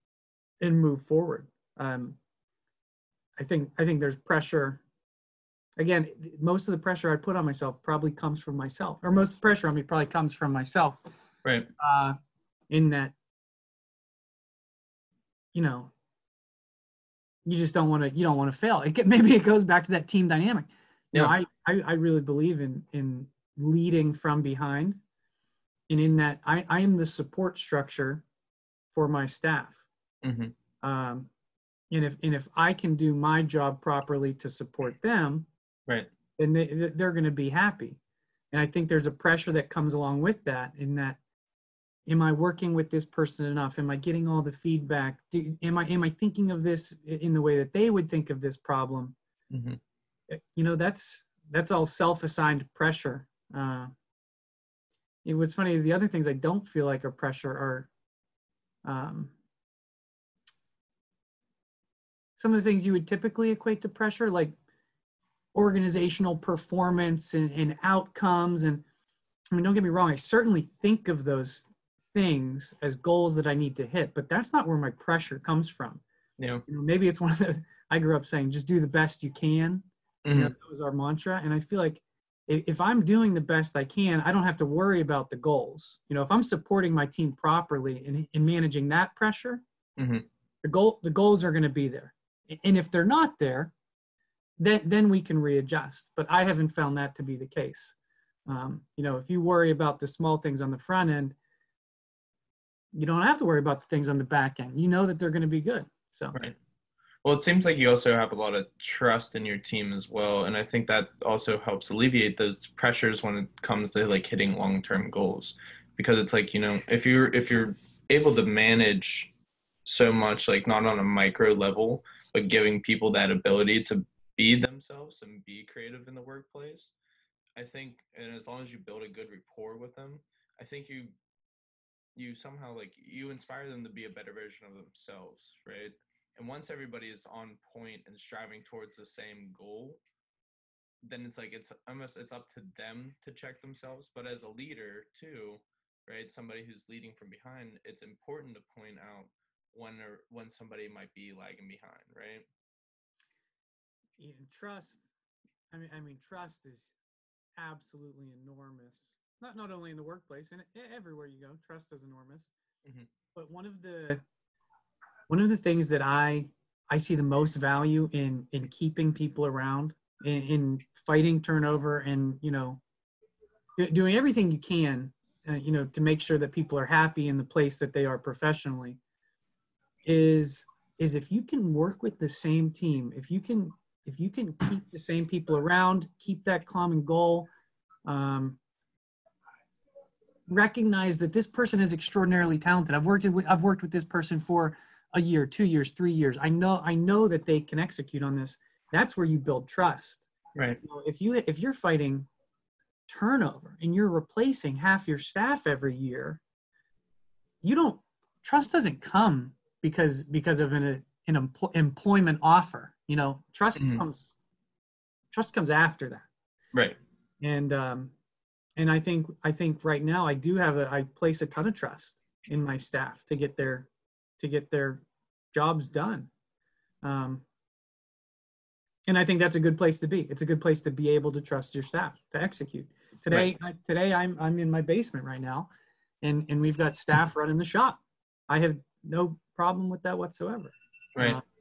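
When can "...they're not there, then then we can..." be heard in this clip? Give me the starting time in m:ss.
1:32.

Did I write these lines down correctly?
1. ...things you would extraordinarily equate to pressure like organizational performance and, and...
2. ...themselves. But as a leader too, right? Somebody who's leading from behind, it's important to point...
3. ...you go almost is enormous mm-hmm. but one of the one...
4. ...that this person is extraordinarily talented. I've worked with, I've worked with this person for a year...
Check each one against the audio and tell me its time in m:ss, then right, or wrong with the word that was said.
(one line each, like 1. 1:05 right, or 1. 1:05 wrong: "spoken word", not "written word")
1. 1:02 wrong: "typically", not "extraordinarily"
2. 2:23 right
3. 2:41 wrong: "trust", not "almost"
4. 3:11 right.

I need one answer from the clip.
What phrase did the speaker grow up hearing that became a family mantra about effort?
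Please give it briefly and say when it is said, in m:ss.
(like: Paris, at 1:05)
just do the best you can, at 1:18.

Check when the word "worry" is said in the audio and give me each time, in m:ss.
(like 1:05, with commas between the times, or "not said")
1:24, 1:39, 1:43.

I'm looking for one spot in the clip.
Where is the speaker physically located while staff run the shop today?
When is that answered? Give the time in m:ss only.
3:54.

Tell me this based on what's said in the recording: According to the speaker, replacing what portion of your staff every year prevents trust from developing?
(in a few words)
half.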